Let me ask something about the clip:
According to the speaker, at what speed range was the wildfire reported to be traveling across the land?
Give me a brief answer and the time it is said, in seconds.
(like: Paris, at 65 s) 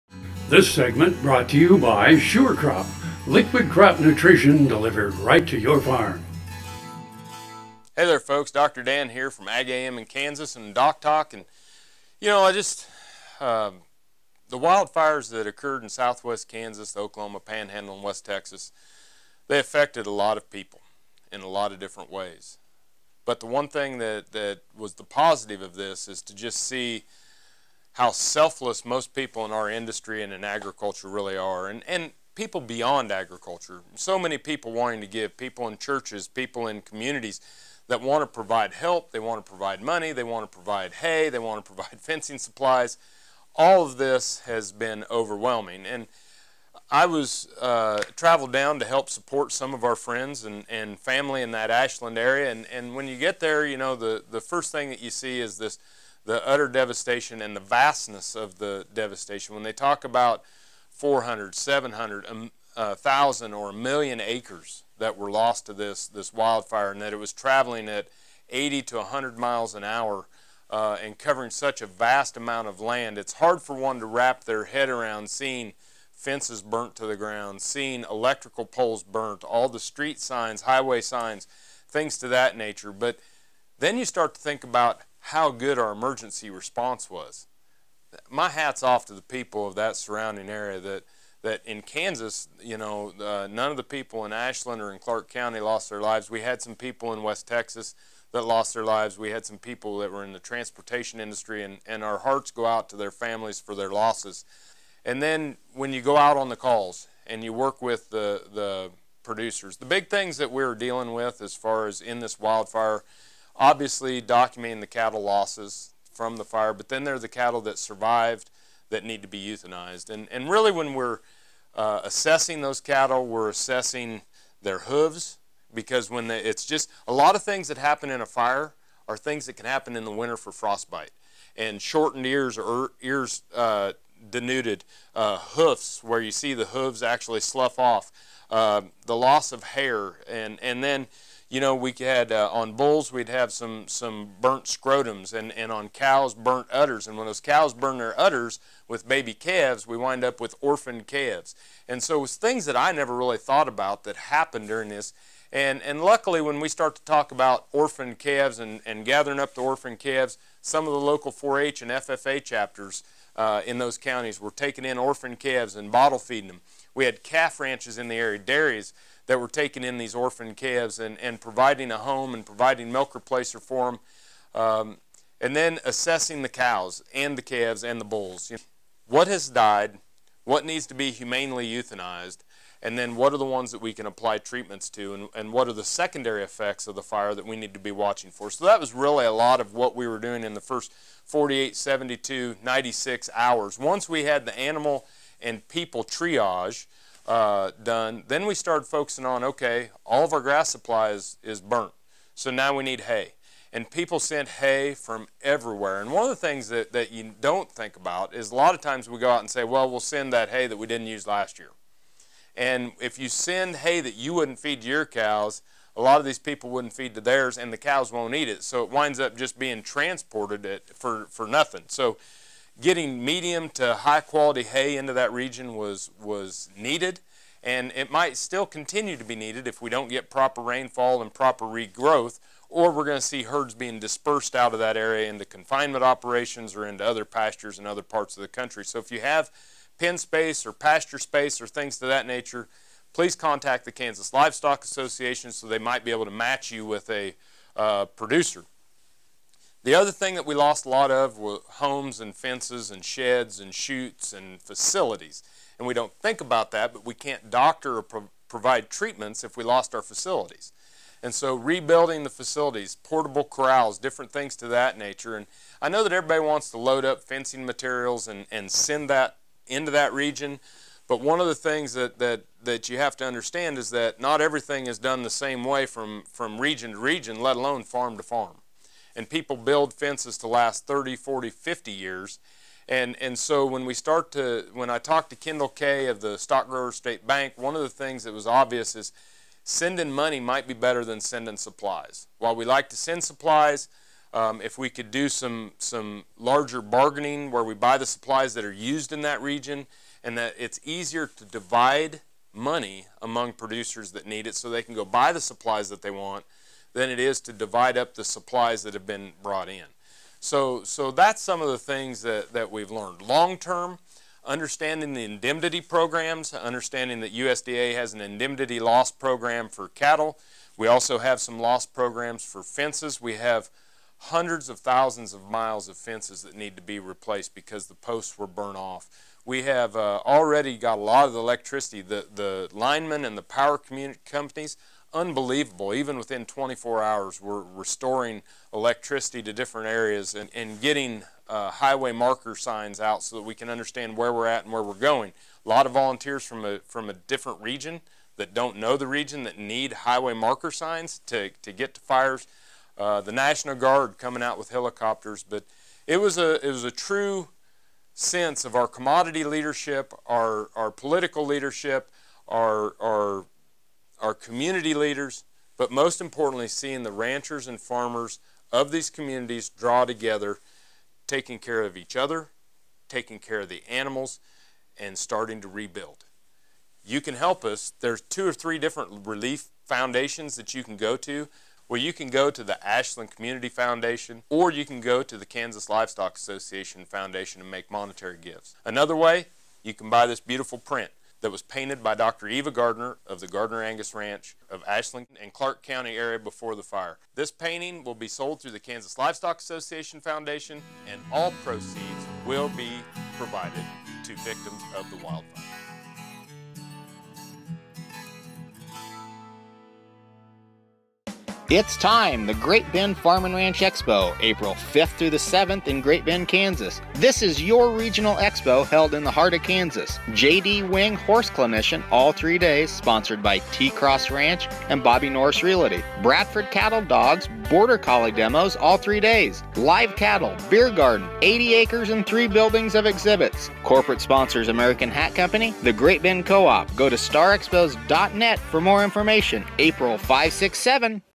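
80 to 100 miles an hour, at 68 s.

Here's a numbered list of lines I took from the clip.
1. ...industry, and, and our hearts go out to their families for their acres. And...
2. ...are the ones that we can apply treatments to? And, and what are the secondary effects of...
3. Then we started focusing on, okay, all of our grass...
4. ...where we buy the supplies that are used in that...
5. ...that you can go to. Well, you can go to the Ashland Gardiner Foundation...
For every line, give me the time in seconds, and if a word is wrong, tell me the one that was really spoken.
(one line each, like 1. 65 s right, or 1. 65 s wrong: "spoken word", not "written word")
1. 101 s wrong: "losses", not "acres"
2. 183 s right
3. 198 s right
4. 297 s right
5. 380 s wrong: "Community", not "Gardiner".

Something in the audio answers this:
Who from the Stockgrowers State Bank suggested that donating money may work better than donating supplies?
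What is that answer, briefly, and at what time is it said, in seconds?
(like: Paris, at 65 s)
Kendall Kay, at 285 s.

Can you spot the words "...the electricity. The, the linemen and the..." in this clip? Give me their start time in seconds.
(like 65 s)
331 s.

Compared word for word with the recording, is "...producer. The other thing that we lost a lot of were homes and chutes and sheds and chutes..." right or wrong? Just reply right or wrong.
wrong.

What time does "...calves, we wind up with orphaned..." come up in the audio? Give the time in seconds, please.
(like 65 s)
149 s.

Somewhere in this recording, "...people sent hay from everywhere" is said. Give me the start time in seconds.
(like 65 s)
203 s.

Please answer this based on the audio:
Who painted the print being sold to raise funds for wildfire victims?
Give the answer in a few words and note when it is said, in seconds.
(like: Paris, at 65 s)
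Dr. Eva Gardiner, at 392 s.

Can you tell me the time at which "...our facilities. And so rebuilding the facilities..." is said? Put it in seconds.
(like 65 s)
259 s.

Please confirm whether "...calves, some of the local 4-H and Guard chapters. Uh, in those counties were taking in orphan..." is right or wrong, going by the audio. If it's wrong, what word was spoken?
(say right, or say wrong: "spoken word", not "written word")
wrong: "FFA", not "Guard".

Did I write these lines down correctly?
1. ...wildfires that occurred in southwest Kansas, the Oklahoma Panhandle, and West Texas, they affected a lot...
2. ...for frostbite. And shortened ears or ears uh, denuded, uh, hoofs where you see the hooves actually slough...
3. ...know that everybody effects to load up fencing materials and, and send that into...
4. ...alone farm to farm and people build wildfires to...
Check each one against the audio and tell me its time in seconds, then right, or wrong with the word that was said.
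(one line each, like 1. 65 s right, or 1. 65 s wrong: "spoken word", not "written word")
1. 14 s right
2. 130 s right
3. 265 s wrong: "wants", not "effects"
4. 277 s wrong: "fences", not "wildfires".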